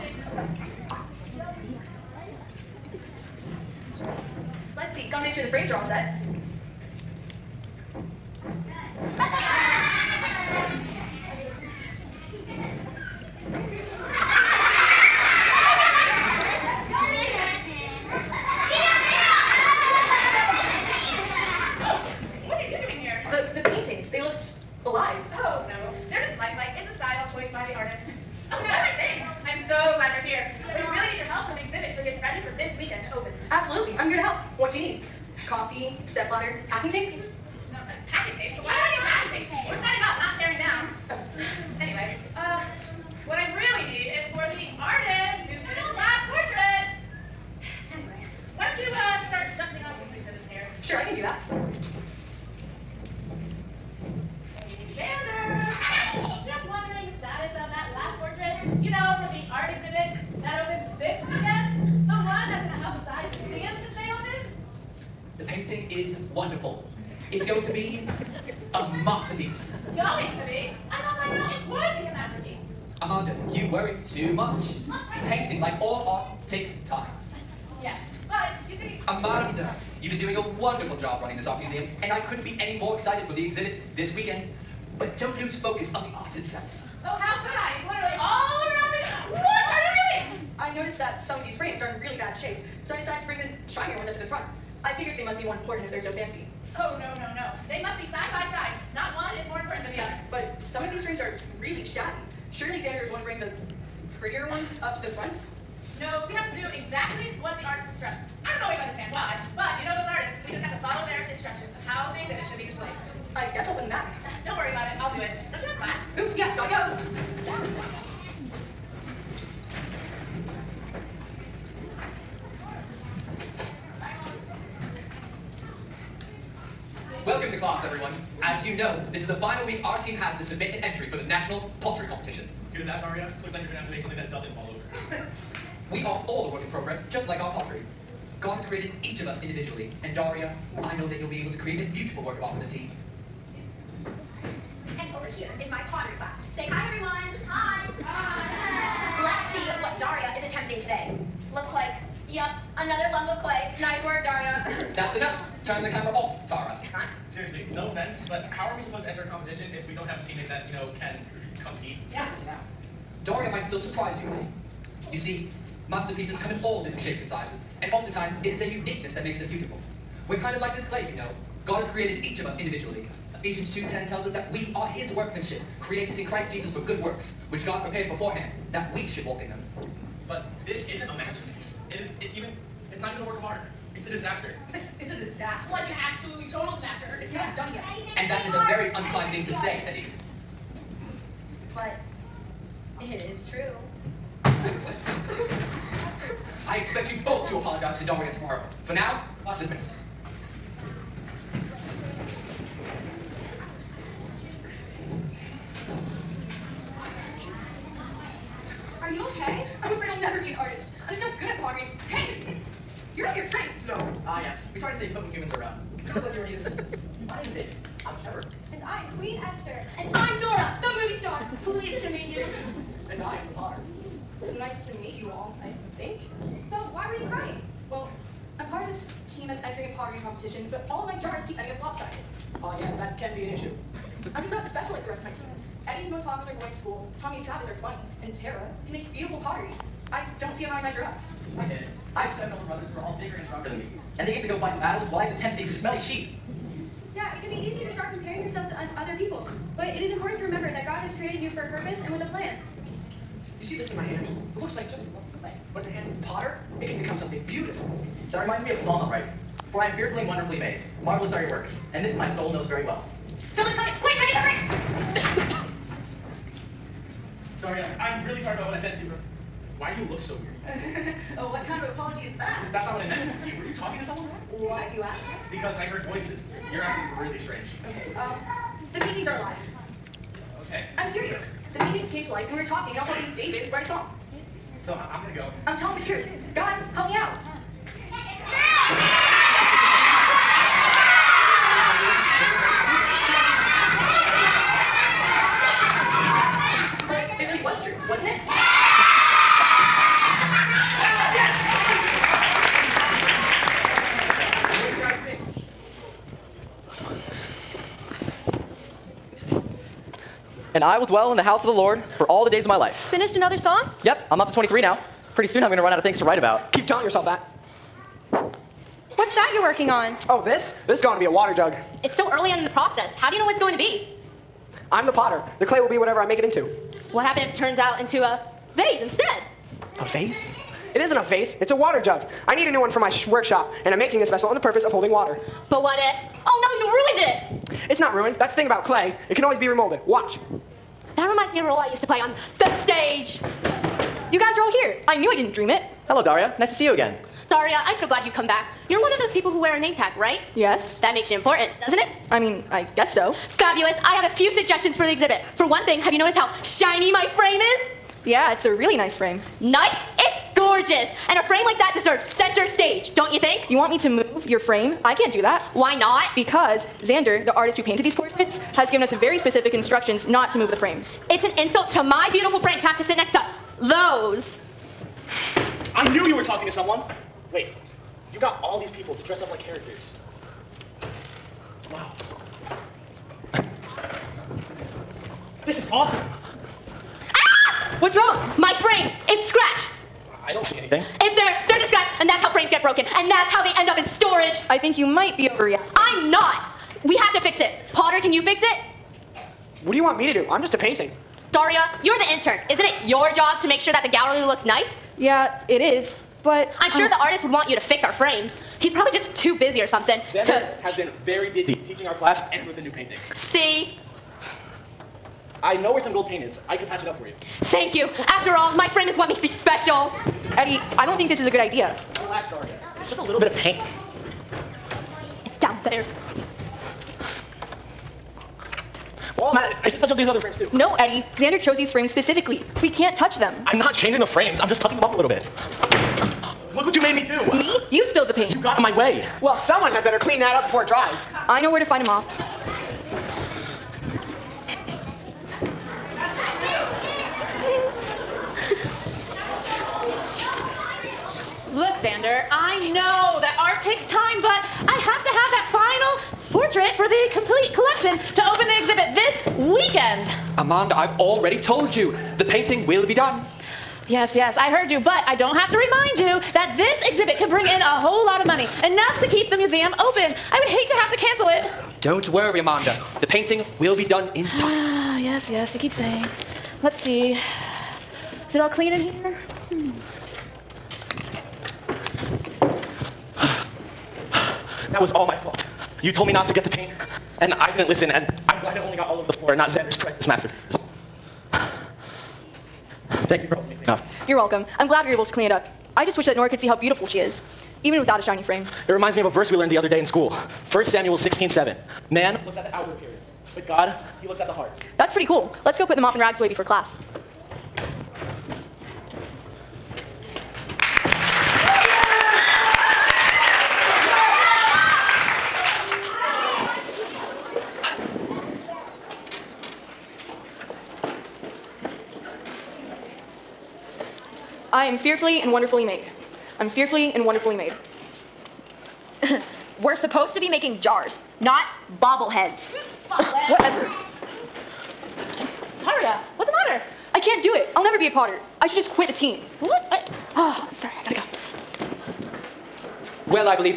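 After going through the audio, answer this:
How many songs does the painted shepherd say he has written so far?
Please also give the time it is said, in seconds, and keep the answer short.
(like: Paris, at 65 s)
23, at 314 s.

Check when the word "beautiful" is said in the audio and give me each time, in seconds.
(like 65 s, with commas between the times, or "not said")
141 s, 169 s, 239 s, 257 s, 372 s, 496 s.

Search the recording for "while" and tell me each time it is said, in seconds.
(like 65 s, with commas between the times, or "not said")
245 s, 429 s.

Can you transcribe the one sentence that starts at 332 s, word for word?
I need a new one for my workshop, and I'm making this vessel on the purpose of holding water.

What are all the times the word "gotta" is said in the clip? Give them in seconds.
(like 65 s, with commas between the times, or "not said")
116 s, 541 s.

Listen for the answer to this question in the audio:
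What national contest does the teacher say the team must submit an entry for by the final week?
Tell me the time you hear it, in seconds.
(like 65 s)
131 s.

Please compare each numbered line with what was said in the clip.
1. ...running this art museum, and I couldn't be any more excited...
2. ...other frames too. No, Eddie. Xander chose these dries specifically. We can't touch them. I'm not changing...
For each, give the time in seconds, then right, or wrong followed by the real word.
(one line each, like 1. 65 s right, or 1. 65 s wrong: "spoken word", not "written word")
1. 81 s right
2. 430 s wrong: "frames", not "dries".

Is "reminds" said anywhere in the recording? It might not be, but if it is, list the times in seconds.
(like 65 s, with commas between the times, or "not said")
258 s, 341 s, 465 s, 498 s.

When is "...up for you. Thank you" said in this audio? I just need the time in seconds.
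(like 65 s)
417 s.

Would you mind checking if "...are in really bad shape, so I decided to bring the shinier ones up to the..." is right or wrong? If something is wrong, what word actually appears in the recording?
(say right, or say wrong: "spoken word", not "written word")
right.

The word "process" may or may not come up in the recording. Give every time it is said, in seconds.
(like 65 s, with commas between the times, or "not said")
322 s.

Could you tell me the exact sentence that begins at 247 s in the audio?
Yeah, it can be easy it is important to remember that God has created you for a purpose and with a plan.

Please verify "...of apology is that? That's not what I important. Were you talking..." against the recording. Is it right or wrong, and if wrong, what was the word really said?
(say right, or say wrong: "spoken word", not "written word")
wrong: "meant", not "important".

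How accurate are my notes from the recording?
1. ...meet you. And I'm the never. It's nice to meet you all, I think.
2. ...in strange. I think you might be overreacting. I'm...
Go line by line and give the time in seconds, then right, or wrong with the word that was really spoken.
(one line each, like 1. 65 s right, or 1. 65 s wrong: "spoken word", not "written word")
1. 222 s wrong: "potter", not "never"
2. 393 s wrong: "storage", not "strange".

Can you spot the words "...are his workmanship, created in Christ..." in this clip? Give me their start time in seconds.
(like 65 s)
174 s.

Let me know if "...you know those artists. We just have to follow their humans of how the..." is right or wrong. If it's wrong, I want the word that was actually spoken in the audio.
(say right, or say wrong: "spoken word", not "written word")
wrong: "instructions", not "humans".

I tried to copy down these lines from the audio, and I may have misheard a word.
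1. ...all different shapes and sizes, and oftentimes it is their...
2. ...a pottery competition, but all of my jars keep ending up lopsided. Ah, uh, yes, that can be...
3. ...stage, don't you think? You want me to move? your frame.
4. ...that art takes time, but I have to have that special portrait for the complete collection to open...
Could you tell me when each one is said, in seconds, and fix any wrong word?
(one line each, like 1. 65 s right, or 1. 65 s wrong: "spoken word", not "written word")
1. 166 s right
2. 229 s right
3. 362 s right
4. 453 s wrong: "final", not "special".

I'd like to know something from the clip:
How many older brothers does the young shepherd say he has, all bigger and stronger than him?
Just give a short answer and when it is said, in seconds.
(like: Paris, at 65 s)
7, at 242 s.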